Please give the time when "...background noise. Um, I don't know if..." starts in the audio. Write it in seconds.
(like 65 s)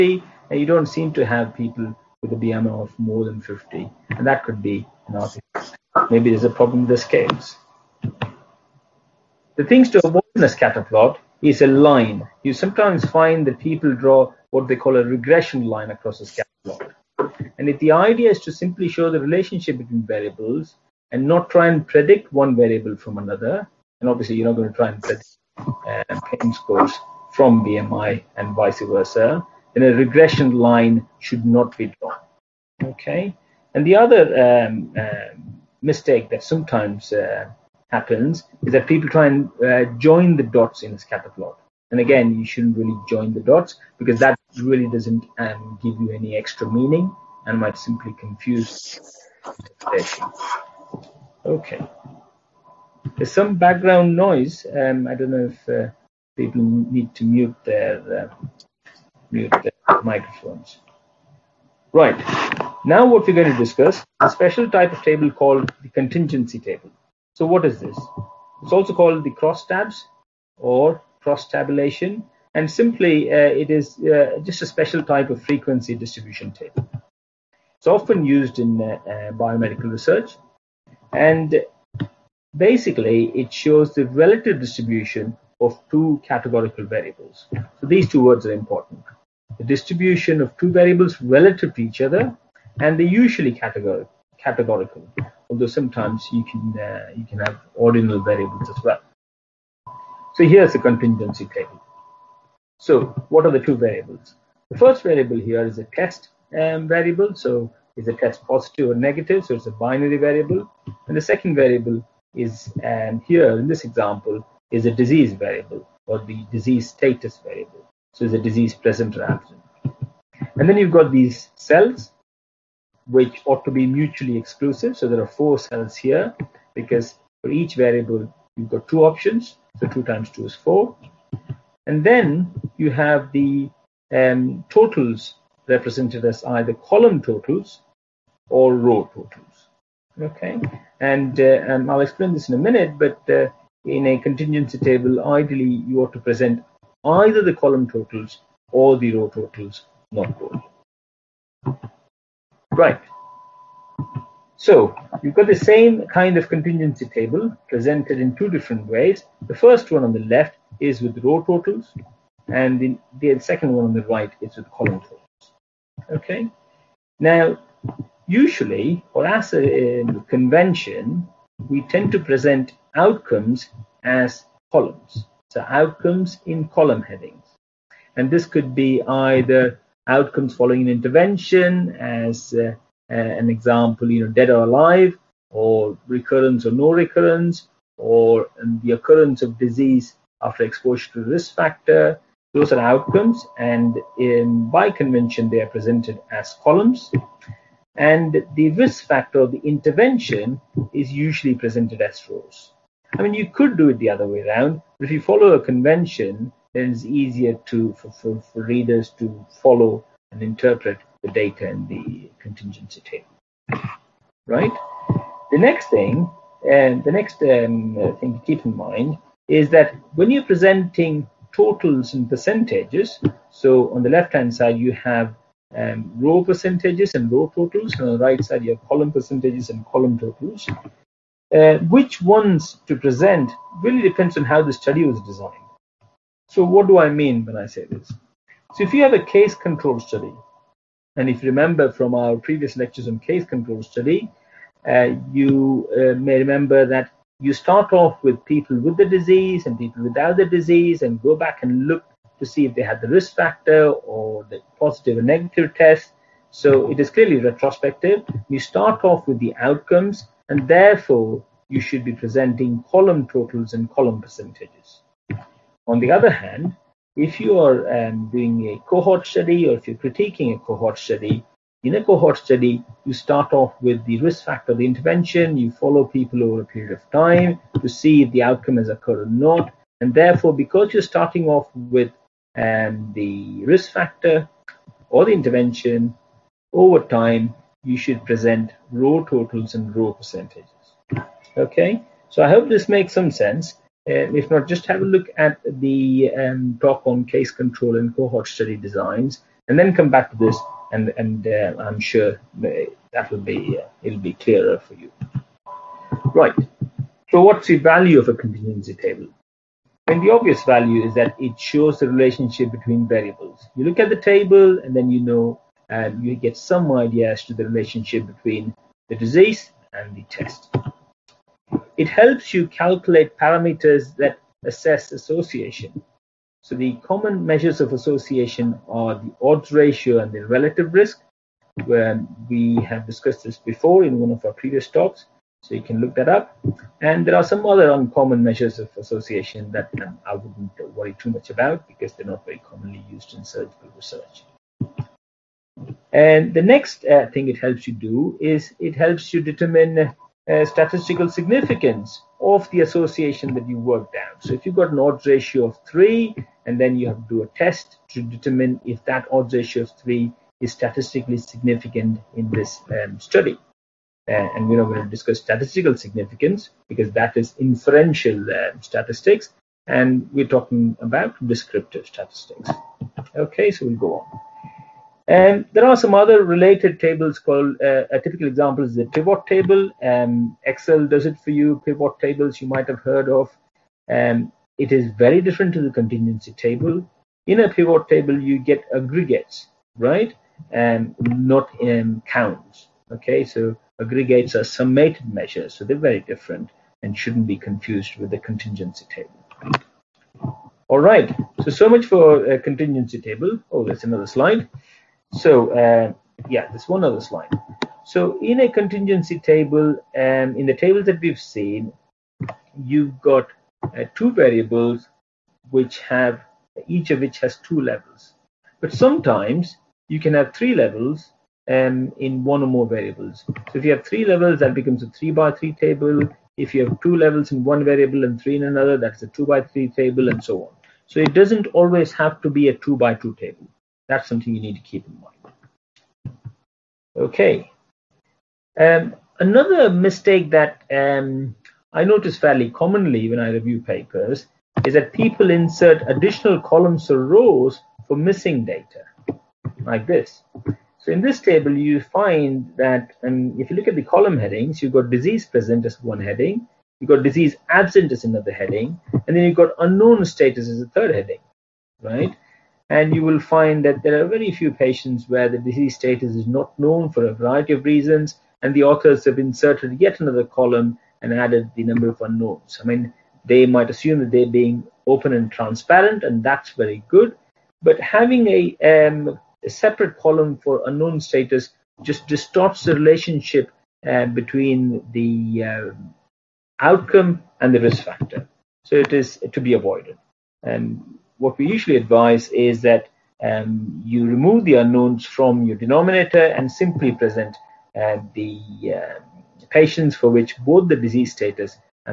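53 s.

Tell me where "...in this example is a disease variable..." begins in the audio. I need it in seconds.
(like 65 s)
113 s.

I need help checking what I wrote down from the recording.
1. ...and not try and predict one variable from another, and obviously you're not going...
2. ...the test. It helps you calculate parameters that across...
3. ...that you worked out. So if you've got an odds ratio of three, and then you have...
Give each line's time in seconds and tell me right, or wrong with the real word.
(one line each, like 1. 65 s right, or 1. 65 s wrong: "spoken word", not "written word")
1. 21 s right
2. 320 s wrong: "assess", not "across"
3. 353 s right.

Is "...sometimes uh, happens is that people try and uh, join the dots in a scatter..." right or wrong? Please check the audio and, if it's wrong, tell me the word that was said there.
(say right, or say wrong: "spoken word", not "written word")
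right.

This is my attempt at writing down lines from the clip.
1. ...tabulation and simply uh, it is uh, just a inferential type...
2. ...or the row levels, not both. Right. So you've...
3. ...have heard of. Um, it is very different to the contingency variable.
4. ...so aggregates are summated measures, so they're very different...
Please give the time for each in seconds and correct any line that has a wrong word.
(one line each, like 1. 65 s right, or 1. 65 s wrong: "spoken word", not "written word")
1. 71 s wrong: "special", not "inferential"
2. 148 s wrong: "totals", not "levels"
3. 382 s wrong: "table", not "variable"
4. 393 s right.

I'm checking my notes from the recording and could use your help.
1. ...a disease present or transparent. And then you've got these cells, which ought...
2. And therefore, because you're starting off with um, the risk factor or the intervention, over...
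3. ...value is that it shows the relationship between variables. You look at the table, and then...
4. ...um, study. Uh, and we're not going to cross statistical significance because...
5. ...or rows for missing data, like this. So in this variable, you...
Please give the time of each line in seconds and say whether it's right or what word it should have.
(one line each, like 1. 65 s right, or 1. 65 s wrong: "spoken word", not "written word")
1. 118 s wrong: "absent", not "transparent"
2. 279 s right
3. 310 s right
4. 363 s wrong: "discuss", not "cross"
5. 447 s wrong: "table", not "variable".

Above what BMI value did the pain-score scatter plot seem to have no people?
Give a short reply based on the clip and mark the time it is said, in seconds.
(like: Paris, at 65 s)
50, at 3 s.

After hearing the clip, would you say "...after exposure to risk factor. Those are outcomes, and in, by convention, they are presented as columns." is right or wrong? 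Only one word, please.
right.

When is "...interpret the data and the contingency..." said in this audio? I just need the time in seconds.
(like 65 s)
210 s.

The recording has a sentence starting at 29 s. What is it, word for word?
Then a regression line should not be drawn.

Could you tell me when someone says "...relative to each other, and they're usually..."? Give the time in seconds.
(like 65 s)
91 s.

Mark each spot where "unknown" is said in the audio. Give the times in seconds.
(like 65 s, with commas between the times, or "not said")
459 s, 472 s, 480 s, 494 s.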